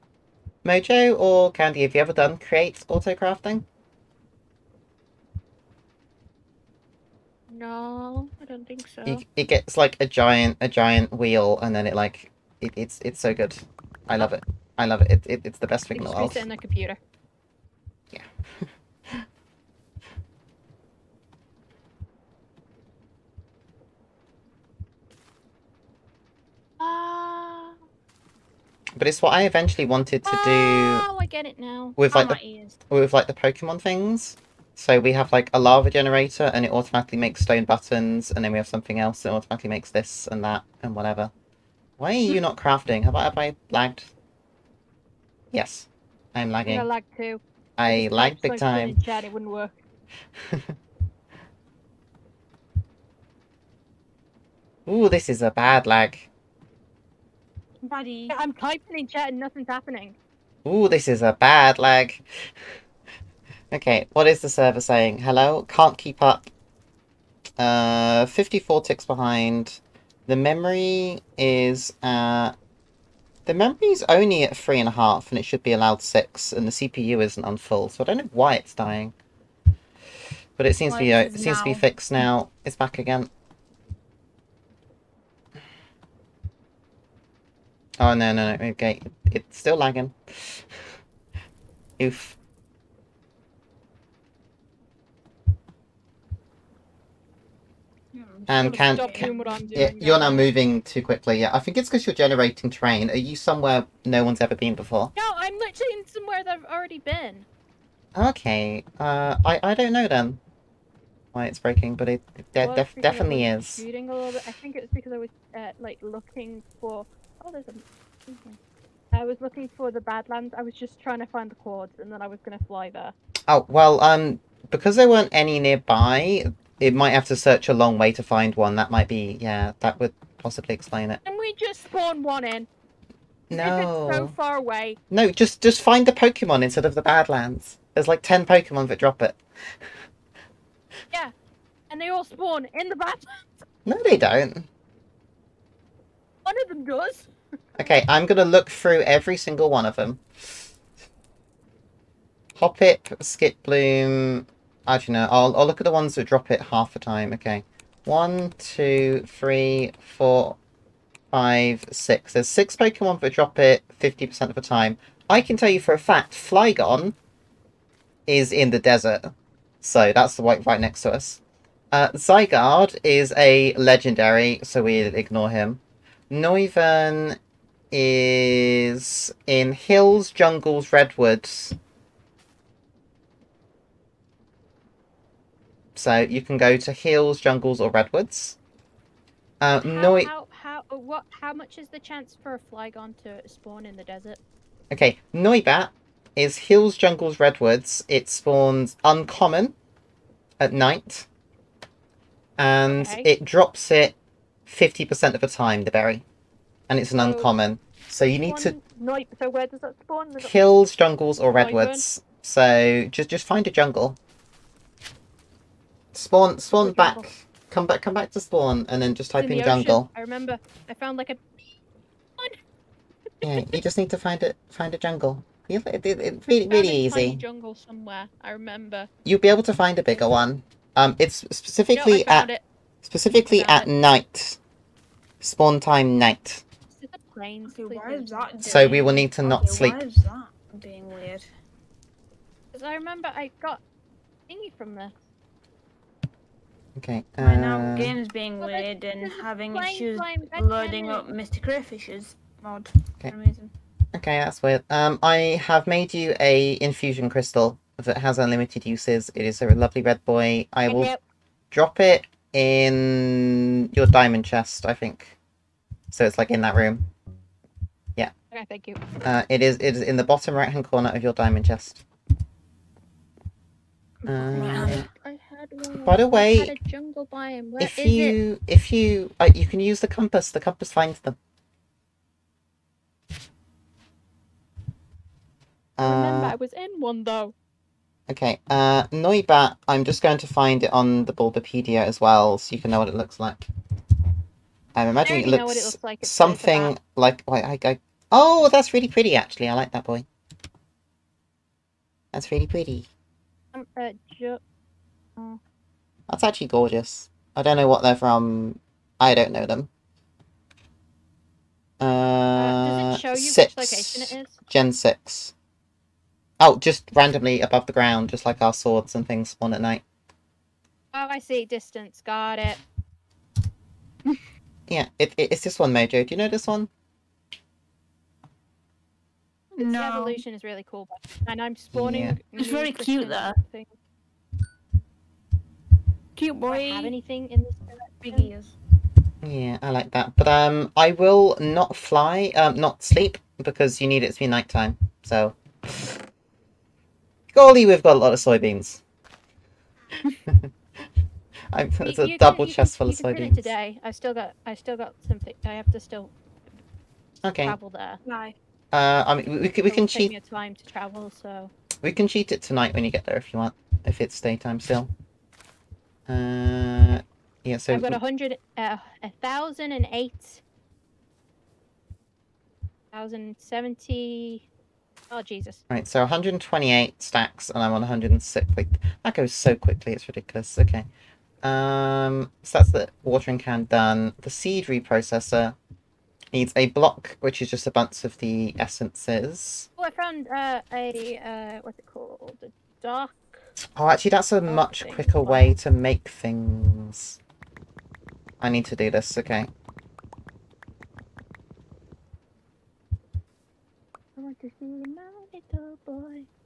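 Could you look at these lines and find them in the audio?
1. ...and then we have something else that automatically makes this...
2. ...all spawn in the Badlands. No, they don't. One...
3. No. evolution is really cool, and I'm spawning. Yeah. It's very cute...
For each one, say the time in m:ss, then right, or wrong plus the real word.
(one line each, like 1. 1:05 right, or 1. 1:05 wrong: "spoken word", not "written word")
1. 0:38 right
2. 2:22 right
3. 5:29 right.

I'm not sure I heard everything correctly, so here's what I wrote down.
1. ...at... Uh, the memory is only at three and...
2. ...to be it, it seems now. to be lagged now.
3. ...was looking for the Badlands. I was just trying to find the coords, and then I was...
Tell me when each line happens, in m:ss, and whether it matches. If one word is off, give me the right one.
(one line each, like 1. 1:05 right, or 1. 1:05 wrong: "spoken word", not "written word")
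1. 1:12 right
2. 1:20 wrong: "fixed", not "lagged"
3. 1:59 right.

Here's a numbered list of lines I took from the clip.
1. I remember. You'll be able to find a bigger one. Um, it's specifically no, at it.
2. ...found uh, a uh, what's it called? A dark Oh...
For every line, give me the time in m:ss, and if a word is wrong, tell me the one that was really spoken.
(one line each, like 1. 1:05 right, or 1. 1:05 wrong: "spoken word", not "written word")
1. 3:48 right
2. 6:30 right.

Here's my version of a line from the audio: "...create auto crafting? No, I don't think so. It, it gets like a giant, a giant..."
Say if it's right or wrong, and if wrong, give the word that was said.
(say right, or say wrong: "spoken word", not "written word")
right.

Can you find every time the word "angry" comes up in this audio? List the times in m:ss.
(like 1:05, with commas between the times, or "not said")
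not said.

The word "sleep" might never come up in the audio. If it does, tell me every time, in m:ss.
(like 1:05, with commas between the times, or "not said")
3:59, 5:43.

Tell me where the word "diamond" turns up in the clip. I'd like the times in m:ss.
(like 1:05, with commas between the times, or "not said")
4:24, 4:31.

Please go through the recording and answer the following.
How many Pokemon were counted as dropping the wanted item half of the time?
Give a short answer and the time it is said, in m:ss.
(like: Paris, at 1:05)
6, at 2:42.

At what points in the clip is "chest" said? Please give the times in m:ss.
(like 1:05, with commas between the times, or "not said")
4:24, 4:31, 5:52.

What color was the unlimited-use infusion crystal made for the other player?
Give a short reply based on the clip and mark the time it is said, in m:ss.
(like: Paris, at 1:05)
Red, at 4:20.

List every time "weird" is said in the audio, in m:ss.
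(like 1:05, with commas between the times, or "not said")
4:01, 4:08, 4:14.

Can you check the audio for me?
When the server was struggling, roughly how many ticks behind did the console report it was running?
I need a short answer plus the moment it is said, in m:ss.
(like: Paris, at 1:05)
54, at 1:08.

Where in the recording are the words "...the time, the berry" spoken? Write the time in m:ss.
3:25.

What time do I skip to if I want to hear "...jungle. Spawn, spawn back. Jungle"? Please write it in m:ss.
3:33.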